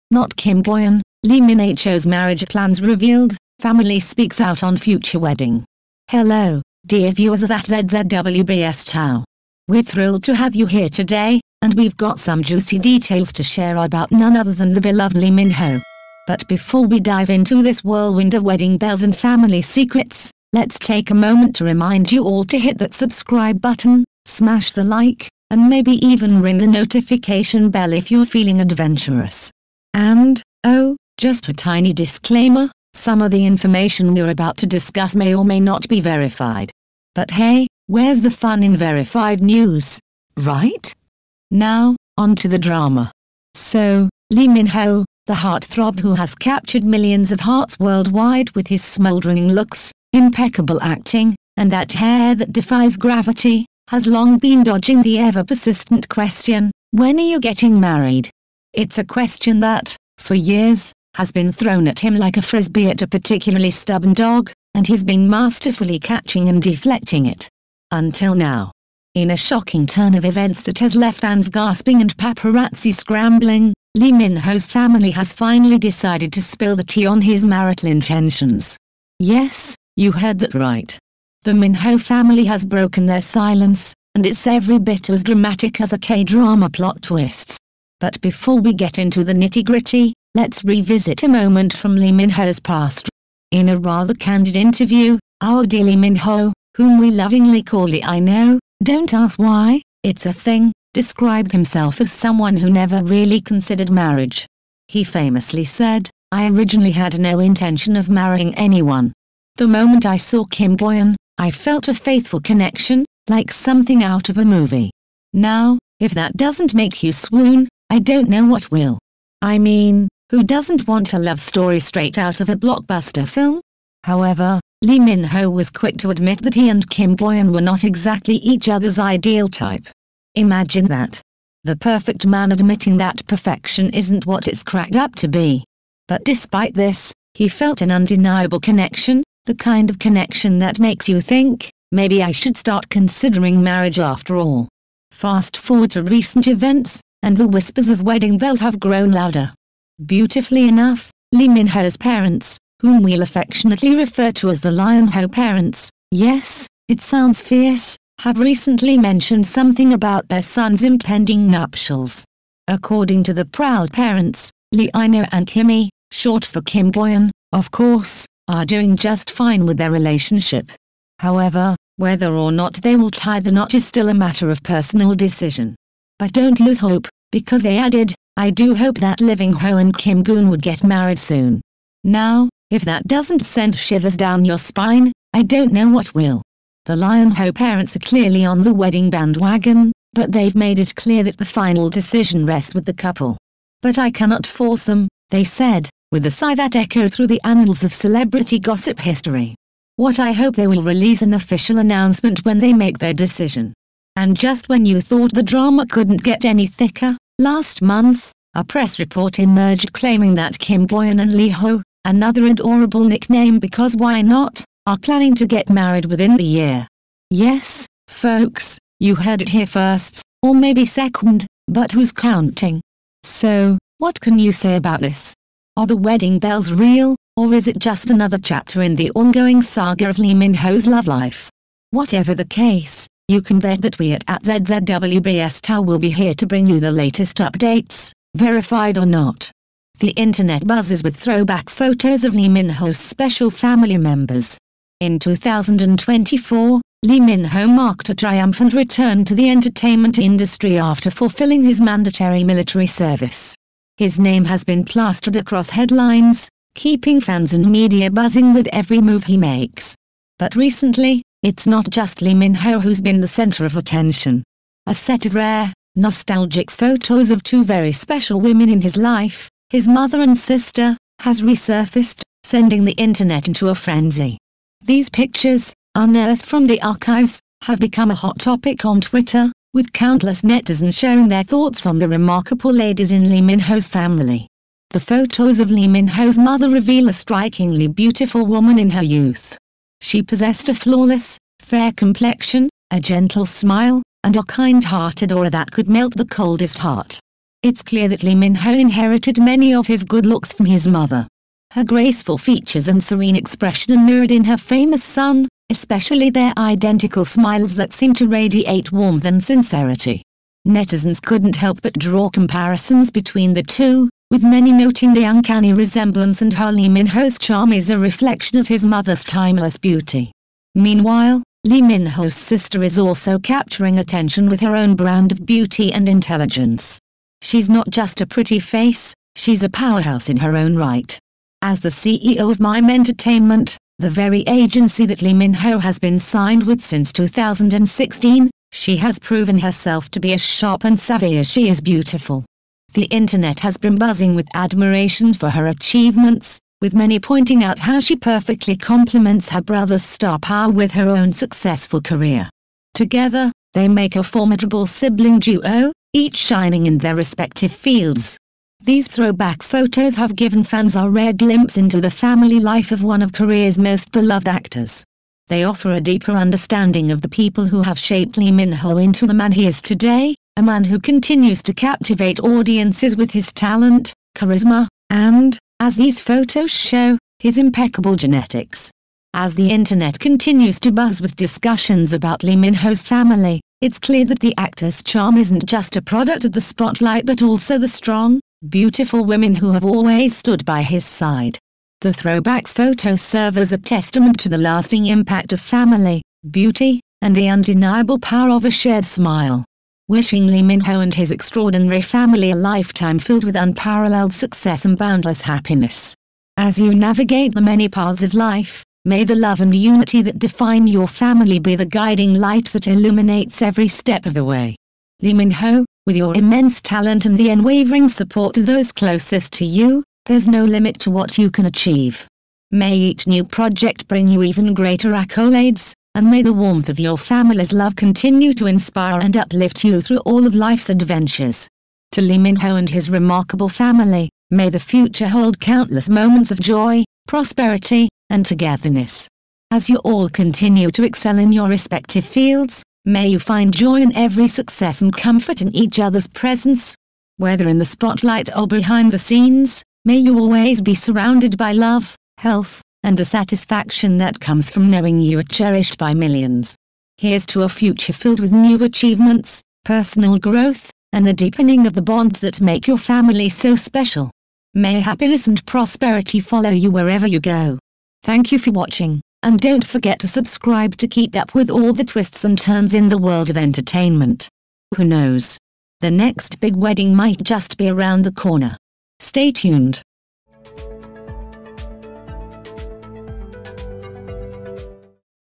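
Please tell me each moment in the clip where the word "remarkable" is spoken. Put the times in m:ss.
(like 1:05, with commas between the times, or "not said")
4:42, 7:13.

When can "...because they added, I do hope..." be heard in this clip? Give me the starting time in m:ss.
2:57.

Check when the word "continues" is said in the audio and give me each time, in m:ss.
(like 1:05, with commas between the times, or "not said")
6:10, 6:20, 7:07, 7:20.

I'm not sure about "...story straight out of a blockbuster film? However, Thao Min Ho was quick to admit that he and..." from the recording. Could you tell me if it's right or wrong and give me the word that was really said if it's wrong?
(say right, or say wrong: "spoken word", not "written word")
wrong: "Lee", not "Thao".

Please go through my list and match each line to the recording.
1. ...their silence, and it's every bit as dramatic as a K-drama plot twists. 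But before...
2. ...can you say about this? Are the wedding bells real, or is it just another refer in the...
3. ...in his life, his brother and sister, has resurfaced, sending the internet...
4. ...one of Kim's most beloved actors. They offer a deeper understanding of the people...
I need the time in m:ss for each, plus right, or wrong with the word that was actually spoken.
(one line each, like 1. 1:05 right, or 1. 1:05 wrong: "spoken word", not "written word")
1. 1:23 right
2. 3:44 wrong: "chapter", not "refer"
3. 4:28 wrong: "mother", not "brother"
4. 6:03 wrong: "Korea", not "Kim".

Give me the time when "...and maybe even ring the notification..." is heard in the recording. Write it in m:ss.
0:25.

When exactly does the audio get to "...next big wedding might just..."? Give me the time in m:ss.
7:56.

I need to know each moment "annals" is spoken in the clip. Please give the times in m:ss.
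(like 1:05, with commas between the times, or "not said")
3:17.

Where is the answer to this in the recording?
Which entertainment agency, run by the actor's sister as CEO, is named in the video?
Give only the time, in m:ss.
5:32.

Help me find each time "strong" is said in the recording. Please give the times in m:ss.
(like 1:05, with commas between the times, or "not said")
6:27.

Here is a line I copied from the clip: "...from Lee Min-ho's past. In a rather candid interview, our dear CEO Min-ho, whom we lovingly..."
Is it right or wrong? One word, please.
wrong.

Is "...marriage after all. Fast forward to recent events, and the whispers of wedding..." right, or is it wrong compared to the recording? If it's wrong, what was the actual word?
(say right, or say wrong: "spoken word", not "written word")
right.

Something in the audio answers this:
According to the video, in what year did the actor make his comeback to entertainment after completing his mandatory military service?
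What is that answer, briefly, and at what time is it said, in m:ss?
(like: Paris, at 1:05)
2024, at 4:05.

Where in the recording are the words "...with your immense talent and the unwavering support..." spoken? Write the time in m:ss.
6:56.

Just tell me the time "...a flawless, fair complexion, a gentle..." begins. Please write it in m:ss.
4:50.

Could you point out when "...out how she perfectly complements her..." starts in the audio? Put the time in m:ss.
5:47.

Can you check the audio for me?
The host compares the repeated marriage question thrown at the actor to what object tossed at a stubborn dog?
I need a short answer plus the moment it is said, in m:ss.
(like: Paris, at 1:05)
A frisbee, at 1:02.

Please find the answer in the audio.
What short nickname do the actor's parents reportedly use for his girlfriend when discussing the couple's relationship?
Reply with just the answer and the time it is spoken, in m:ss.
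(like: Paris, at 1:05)
Kimmy, at 2:45.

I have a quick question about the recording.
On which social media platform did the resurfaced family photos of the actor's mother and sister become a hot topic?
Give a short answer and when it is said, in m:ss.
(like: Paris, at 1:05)
Twitter, at 4:39.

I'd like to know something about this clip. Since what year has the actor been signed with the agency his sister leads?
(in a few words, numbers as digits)
2016.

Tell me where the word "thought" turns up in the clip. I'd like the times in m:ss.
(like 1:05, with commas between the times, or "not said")
3:24, 4:41.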